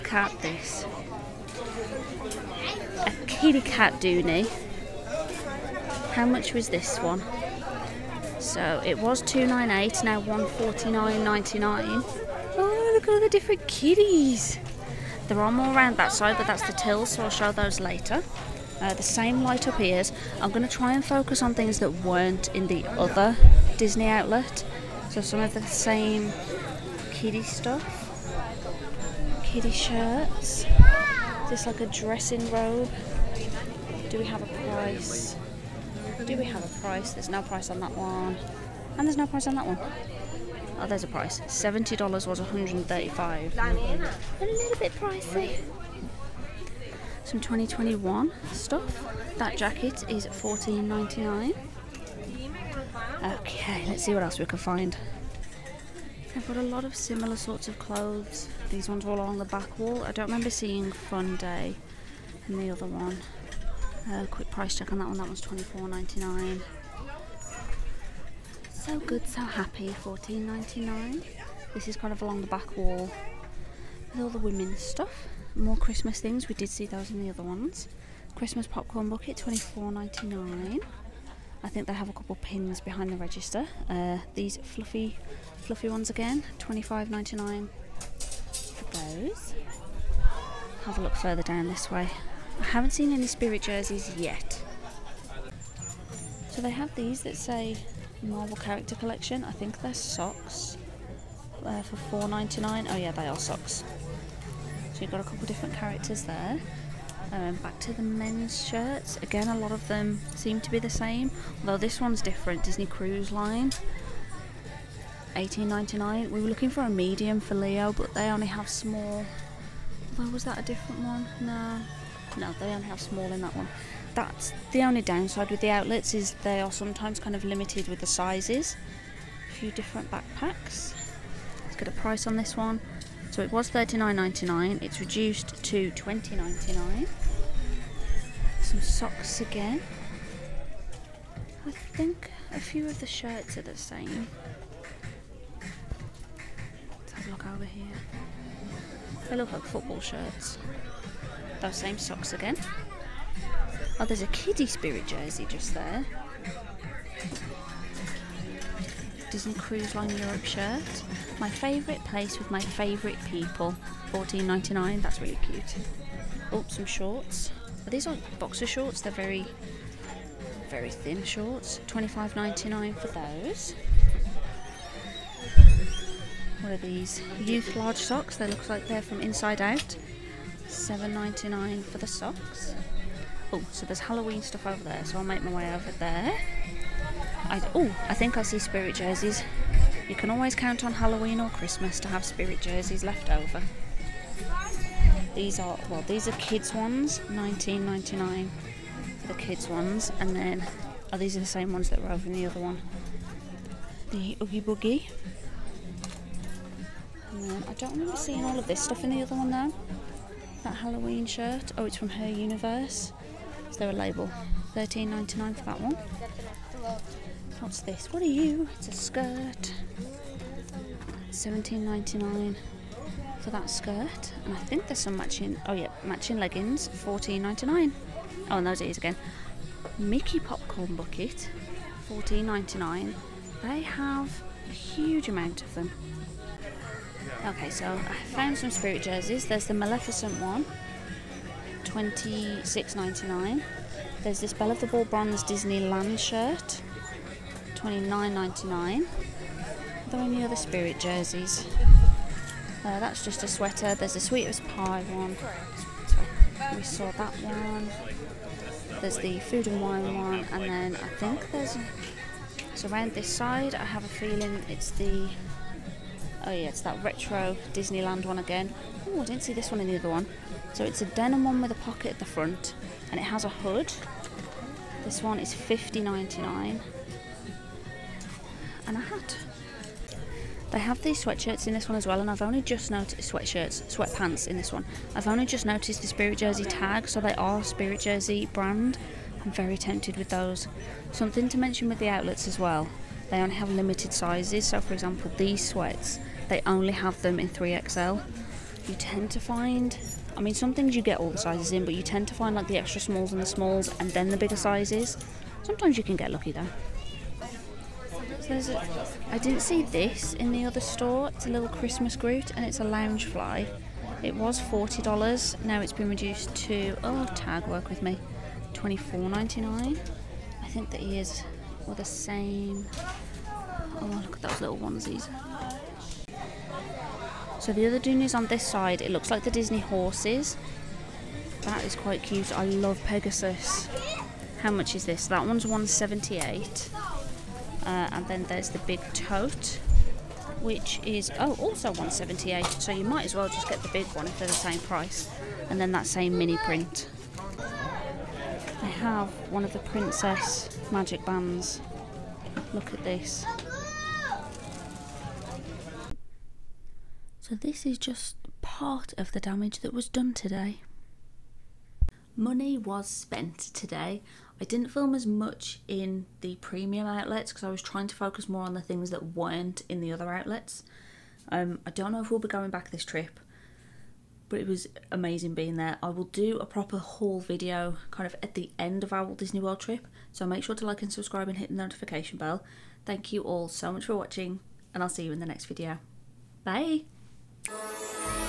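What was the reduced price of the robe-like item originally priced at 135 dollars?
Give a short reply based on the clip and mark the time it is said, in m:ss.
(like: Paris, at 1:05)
$70, at 0:41.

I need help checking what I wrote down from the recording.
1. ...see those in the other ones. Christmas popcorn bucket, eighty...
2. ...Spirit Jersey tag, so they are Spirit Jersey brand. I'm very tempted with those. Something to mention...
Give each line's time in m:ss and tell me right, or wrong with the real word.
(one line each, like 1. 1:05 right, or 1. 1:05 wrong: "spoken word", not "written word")
1. 1:16 wrong: "twenty", not "eighty"
2. 4:46 right.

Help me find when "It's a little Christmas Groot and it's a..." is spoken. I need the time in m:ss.
5:11.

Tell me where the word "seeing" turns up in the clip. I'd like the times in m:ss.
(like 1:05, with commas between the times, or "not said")
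1:00, 3:28.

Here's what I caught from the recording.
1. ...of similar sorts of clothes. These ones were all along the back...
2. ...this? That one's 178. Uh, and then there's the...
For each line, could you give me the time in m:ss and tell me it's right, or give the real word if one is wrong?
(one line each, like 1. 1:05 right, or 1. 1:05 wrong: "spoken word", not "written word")
1. 0:56 right
2. 5:35 right.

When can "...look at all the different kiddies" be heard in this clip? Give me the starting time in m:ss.
0:12.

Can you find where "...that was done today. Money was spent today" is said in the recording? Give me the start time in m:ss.
5:59.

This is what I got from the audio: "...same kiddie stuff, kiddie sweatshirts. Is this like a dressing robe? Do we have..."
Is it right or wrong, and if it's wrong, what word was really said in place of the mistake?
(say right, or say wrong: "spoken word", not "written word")
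wrong: "shirts", not "sweatshirts".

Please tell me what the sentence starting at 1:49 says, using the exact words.
Again, a lot of them seem to be the same, although this one's different.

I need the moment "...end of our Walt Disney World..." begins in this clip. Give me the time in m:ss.
6:18.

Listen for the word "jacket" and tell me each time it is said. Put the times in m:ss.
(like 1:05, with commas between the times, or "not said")
0:49.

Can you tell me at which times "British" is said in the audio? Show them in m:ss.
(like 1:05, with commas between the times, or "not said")
not said.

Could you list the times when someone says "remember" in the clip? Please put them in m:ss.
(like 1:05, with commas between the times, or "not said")
1:00, 3:27.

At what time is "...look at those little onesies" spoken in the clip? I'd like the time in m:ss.
5:24.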